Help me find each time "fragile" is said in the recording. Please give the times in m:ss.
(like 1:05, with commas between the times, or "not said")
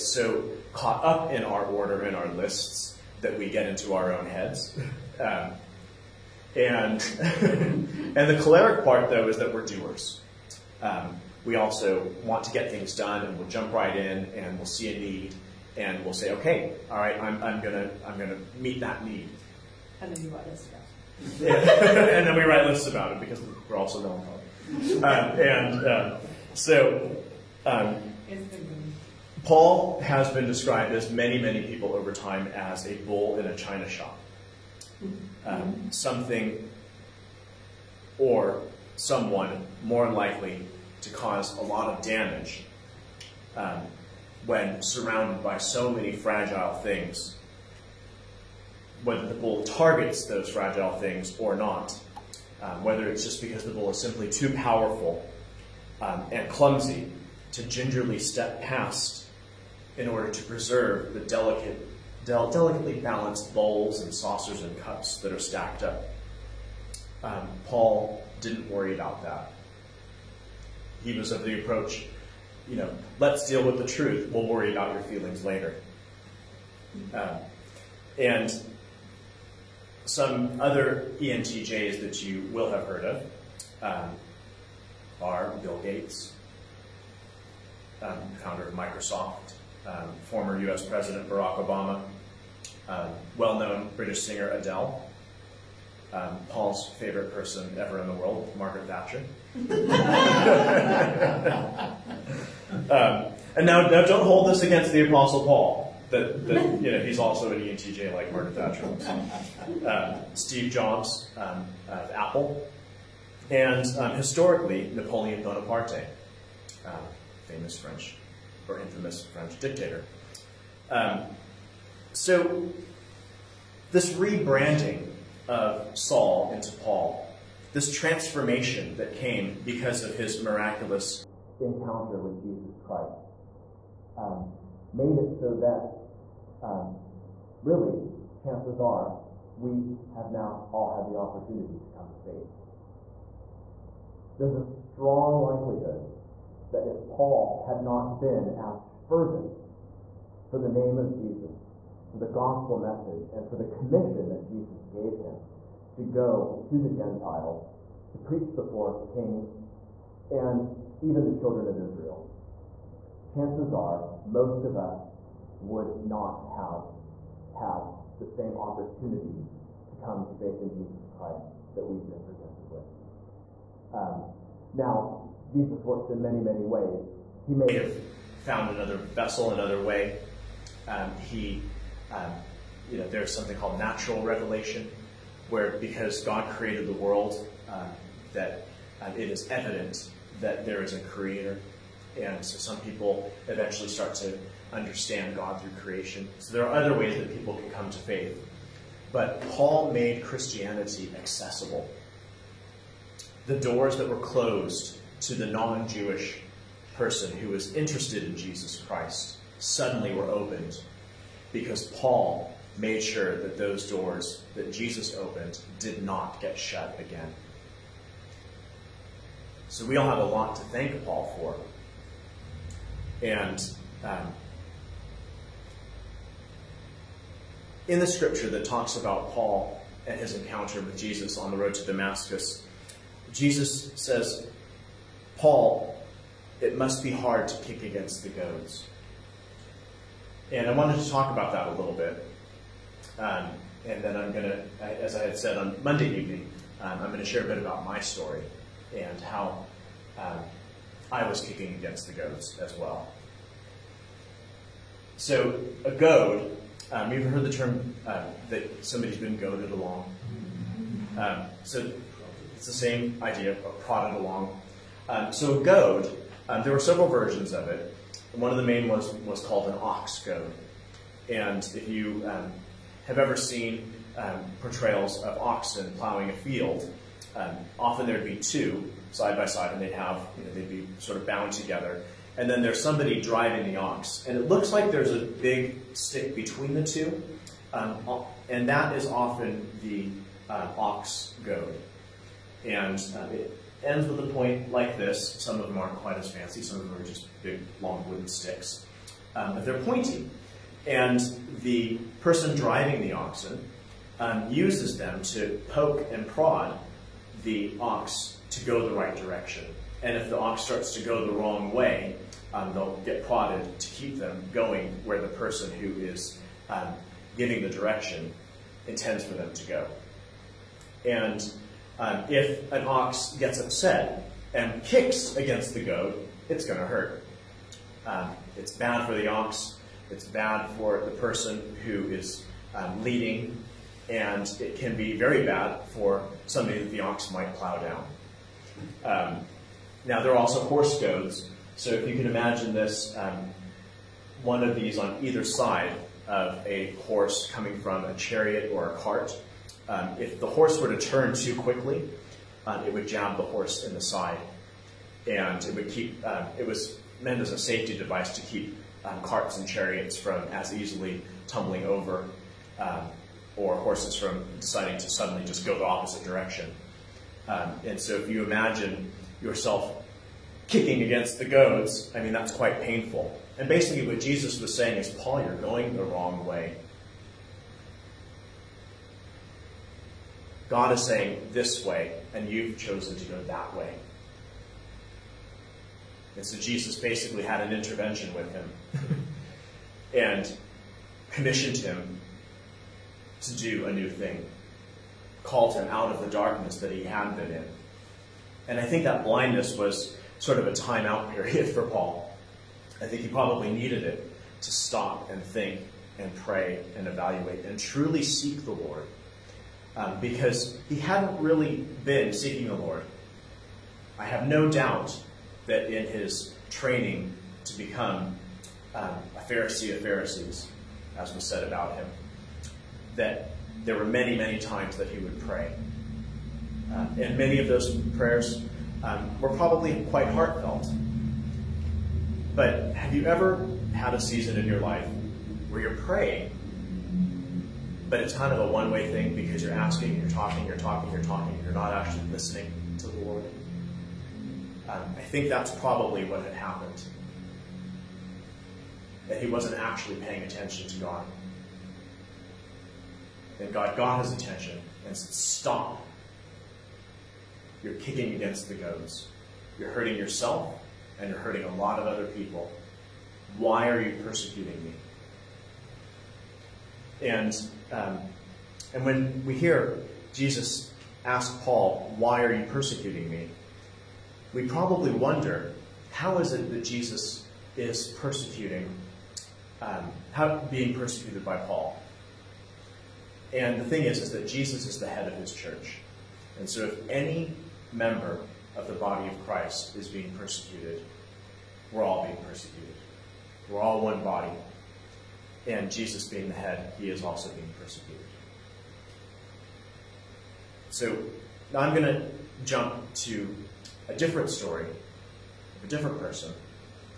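0:46, 0:50.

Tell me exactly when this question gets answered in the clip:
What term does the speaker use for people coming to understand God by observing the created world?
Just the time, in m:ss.
3:03.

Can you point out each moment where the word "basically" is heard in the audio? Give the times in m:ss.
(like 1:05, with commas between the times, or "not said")
6:13, 6:27.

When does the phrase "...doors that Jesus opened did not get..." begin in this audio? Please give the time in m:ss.
3:33.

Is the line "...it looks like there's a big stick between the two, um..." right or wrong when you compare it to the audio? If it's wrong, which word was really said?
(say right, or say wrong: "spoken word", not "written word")
right.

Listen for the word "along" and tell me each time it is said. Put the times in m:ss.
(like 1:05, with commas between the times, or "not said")
4:19, 4:24.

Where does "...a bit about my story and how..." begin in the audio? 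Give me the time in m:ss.
4:07.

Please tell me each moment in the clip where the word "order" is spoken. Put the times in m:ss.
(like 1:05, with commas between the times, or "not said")
0:01, 1:00.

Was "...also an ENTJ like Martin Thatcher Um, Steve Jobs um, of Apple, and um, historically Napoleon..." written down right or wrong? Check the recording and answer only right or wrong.
right.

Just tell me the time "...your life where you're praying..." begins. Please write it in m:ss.
7:14.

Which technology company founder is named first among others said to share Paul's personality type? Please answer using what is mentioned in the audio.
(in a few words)
Bill Gates.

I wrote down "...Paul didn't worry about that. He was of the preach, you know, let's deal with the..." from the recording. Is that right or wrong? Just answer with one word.
wrong.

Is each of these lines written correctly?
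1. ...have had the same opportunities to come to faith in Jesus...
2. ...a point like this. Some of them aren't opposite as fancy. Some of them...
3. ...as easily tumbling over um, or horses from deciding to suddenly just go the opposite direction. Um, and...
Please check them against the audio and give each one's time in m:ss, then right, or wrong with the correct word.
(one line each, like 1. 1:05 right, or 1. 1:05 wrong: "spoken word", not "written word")
1. 2:46 right
2. 4:54 wrong: "quite", not "opposite"
3. 6:00 right.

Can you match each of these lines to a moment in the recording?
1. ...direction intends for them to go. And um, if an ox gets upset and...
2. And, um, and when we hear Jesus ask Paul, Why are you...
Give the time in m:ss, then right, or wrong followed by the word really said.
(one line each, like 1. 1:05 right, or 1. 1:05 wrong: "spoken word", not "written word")
1. 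5:17 right
2. 7:47 right.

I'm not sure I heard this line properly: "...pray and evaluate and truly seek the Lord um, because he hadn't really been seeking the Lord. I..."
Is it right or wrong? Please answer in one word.
right.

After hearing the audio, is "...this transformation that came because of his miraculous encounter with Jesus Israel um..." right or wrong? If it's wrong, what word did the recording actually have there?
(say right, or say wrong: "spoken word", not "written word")
wrong: "Christ", not "Israel".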